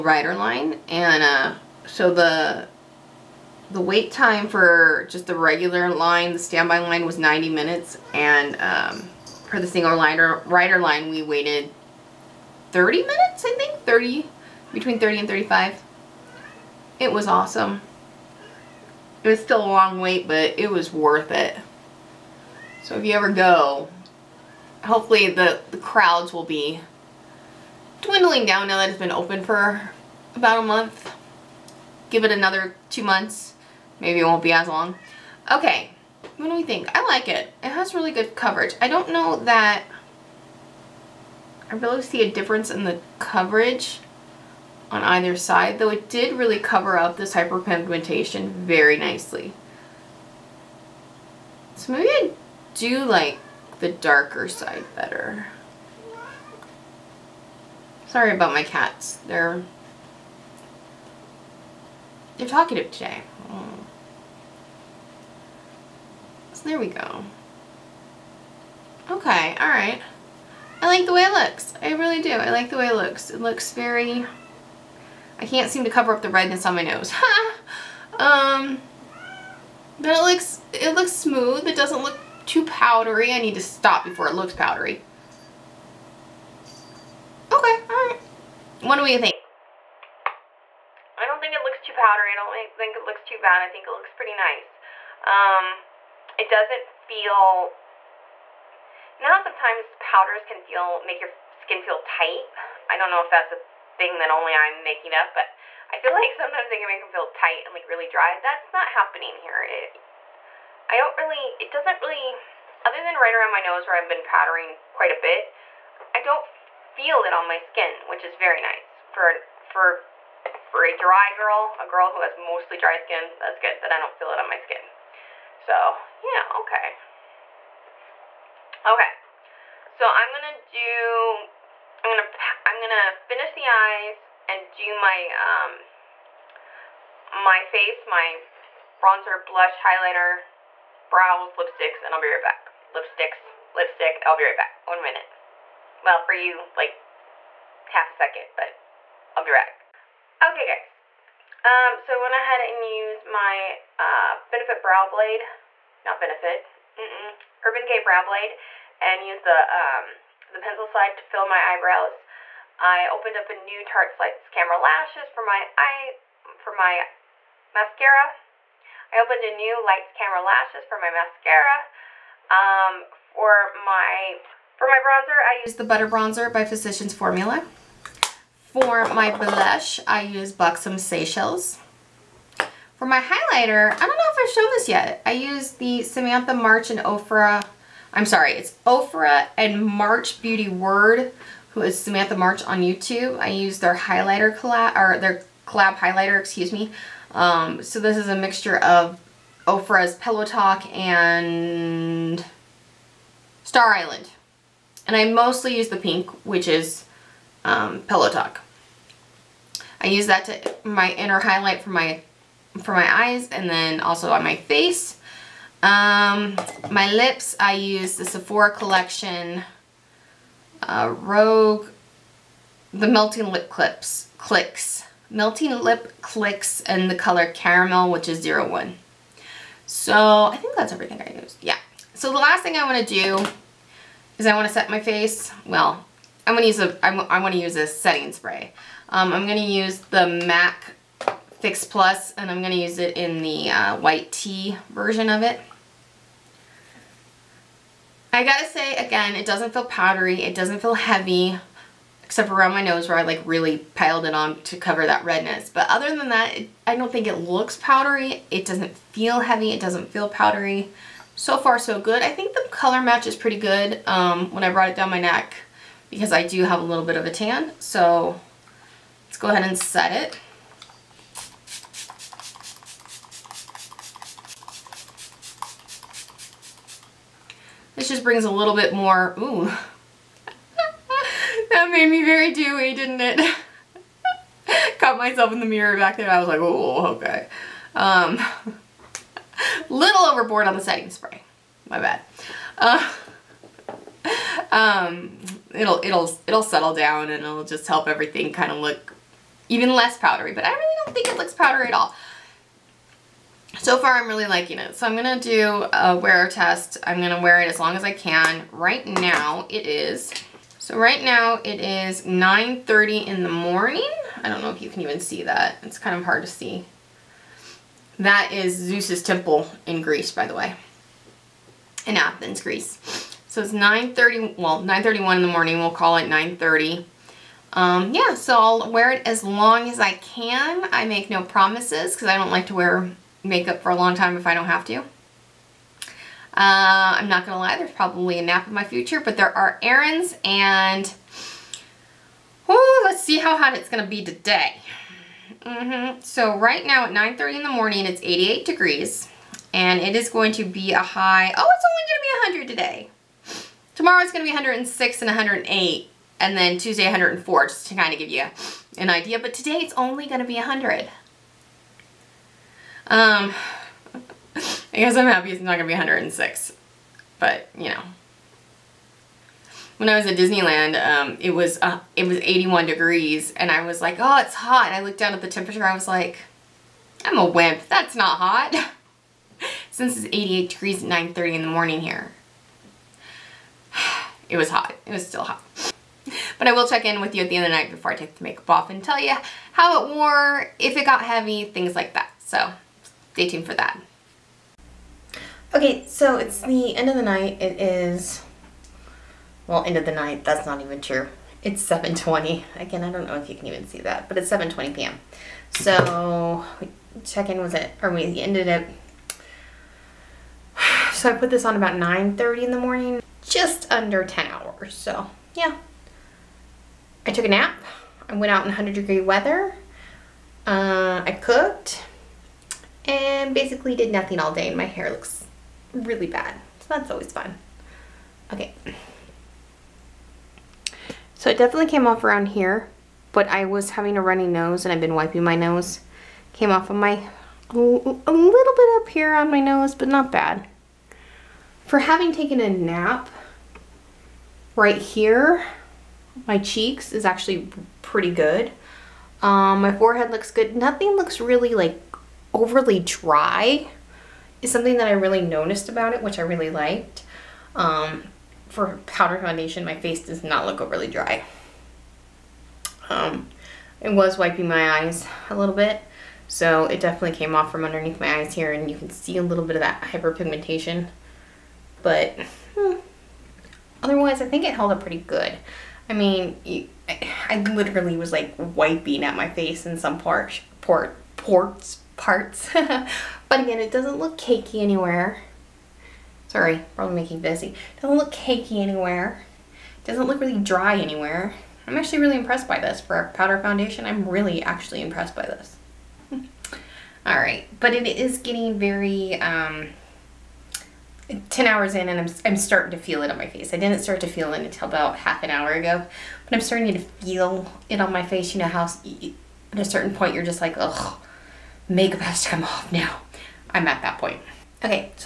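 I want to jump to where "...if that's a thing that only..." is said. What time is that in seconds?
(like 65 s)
103 s.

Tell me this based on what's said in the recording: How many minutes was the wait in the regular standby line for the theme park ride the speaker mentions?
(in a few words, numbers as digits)
90 minutes.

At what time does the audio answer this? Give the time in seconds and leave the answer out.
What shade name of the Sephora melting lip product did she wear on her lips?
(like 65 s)
227 s.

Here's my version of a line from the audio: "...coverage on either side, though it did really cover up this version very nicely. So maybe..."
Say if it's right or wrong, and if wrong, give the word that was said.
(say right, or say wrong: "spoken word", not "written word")
wrong: "hyperpigmentation", not "version".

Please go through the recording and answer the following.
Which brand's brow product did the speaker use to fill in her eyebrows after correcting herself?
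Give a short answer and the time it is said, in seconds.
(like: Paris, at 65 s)
Urban Decay, at 157 s.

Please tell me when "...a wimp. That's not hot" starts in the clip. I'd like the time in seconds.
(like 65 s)
377 s.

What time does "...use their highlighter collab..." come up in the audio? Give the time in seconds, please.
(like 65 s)
193 s.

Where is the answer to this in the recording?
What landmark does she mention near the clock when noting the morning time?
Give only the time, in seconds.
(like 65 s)
318 s.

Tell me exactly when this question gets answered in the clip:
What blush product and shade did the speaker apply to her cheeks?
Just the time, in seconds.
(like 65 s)
180 s.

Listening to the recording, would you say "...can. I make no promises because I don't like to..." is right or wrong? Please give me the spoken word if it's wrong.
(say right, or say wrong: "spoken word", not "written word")
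right.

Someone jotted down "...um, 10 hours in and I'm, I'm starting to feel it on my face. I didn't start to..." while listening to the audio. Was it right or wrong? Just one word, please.
right.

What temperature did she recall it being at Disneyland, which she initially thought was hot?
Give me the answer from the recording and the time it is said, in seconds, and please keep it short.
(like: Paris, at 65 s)
81 degrees, at 372 s.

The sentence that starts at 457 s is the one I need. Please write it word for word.
Um, for powder foundation, my face does not look overly dry.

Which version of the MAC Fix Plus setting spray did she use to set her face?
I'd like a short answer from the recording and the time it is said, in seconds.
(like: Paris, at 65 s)
White tea, at 243 s.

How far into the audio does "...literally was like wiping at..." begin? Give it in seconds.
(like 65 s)
477 s.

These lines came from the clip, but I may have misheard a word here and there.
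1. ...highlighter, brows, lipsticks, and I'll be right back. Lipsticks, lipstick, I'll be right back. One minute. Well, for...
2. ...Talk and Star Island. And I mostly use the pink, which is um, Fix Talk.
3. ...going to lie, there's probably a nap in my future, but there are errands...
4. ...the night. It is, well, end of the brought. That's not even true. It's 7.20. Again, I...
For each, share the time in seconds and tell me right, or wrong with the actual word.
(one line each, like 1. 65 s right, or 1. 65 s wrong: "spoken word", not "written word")
1. 139 s right
2. 200 s wrong: "Pillow", not "Fix"
3. 337 s right
4. 397 s wrong: "night", not "brought".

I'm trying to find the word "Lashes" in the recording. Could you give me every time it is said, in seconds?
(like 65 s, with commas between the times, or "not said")
164 s, 170 s.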